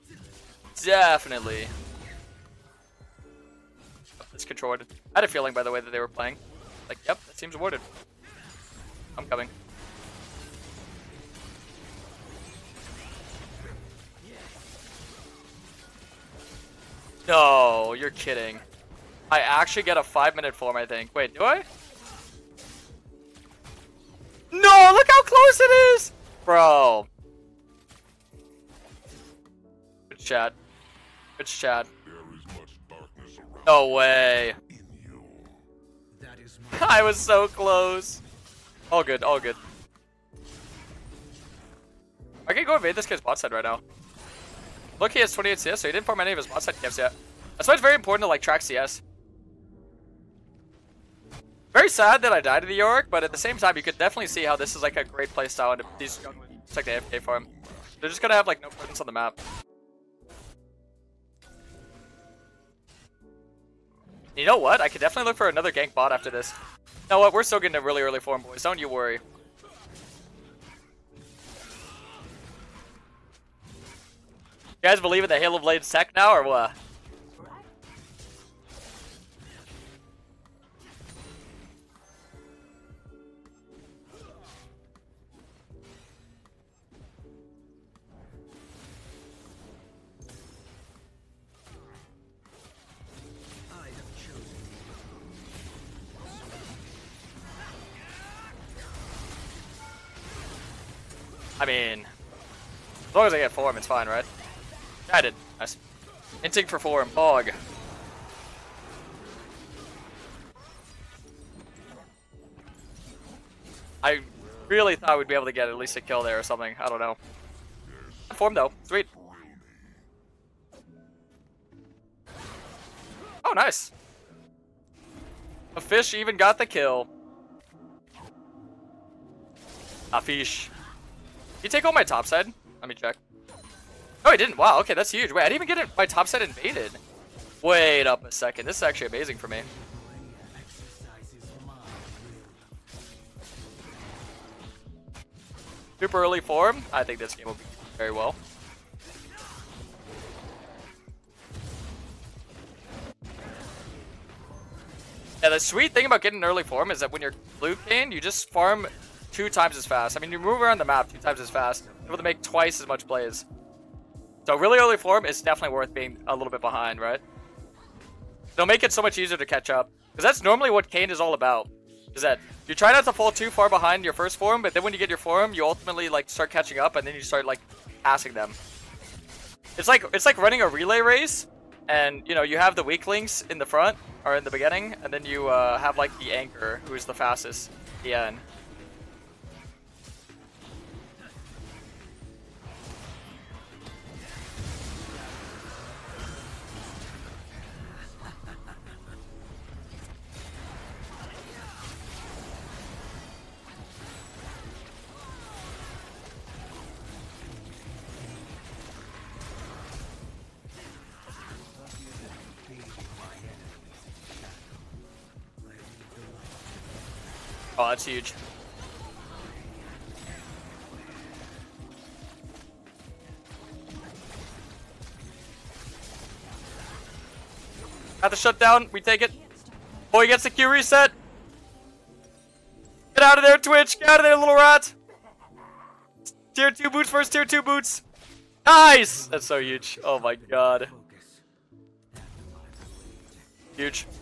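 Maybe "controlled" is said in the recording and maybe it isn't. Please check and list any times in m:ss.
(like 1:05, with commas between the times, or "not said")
0:04.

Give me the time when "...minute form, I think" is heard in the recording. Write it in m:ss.
0:20.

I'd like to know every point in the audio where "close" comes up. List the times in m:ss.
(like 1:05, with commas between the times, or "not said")
0:25, 0:37.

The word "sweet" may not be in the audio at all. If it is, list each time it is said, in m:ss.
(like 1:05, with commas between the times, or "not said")
1:58, 2:35.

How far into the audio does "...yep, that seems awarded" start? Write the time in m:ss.
0:07.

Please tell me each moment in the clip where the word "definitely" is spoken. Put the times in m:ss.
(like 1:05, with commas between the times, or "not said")
0:00, 0:53, 1:05, 2:45.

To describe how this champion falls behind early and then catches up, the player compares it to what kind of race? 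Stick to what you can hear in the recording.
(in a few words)
A relay race.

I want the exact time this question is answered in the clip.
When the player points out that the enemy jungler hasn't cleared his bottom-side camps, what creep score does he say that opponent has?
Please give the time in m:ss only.
0:45.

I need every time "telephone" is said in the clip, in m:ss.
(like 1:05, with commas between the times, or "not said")
not said.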